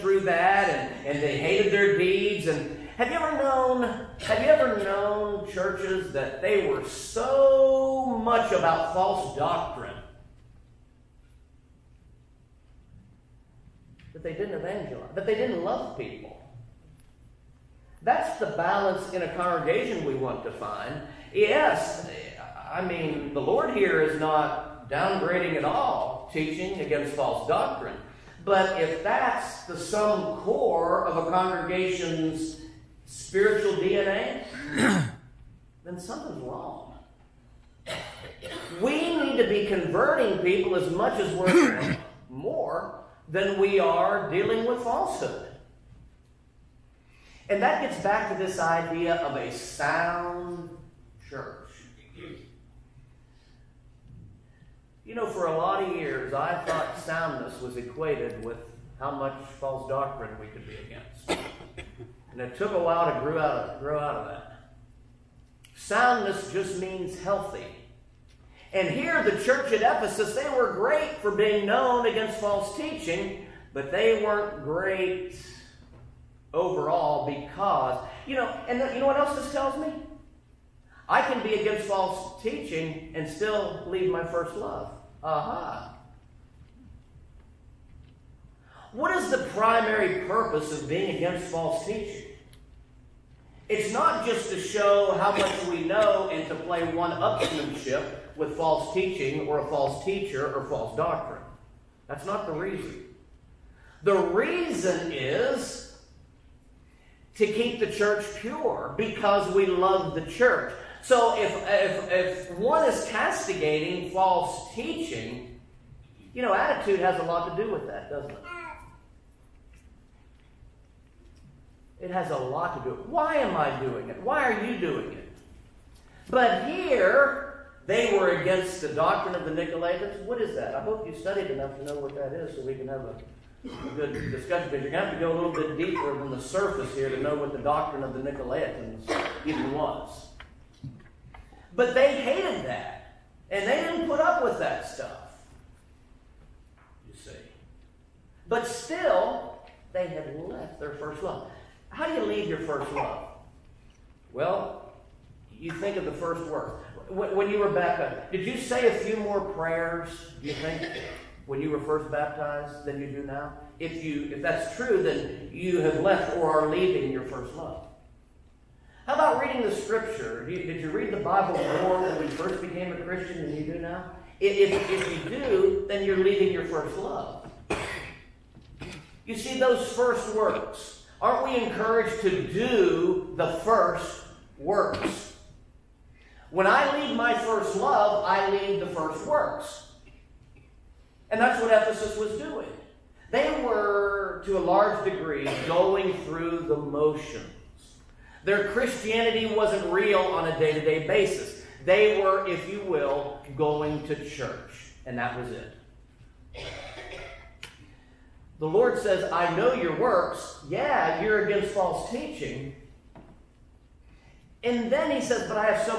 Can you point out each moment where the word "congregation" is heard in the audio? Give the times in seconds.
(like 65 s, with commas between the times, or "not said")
19 s, 31 s.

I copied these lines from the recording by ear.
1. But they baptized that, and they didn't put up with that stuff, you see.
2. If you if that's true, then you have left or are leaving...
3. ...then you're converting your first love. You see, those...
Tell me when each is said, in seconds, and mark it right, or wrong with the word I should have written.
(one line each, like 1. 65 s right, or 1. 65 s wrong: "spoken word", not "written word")
1. 141 s wrong: "hated", not "baptized"
2. 163 s right
3. 175 s wrong: "leaving", not "converting".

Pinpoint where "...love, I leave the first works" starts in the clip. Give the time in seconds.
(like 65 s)
187 s.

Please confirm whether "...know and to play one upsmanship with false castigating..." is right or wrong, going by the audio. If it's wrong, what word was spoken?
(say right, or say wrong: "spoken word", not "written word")
wrong: "teaching", not "castigating".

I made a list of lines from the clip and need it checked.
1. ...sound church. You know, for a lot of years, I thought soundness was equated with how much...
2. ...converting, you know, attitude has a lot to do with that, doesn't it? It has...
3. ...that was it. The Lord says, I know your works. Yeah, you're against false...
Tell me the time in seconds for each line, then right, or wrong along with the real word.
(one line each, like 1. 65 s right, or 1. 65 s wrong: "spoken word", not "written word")
1. 49 s right
2. 114 s wrong: "teaching", not "converting"
3. 205 s right.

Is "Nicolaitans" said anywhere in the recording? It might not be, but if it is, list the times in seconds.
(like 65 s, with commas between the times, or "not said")
129 s, 138 s.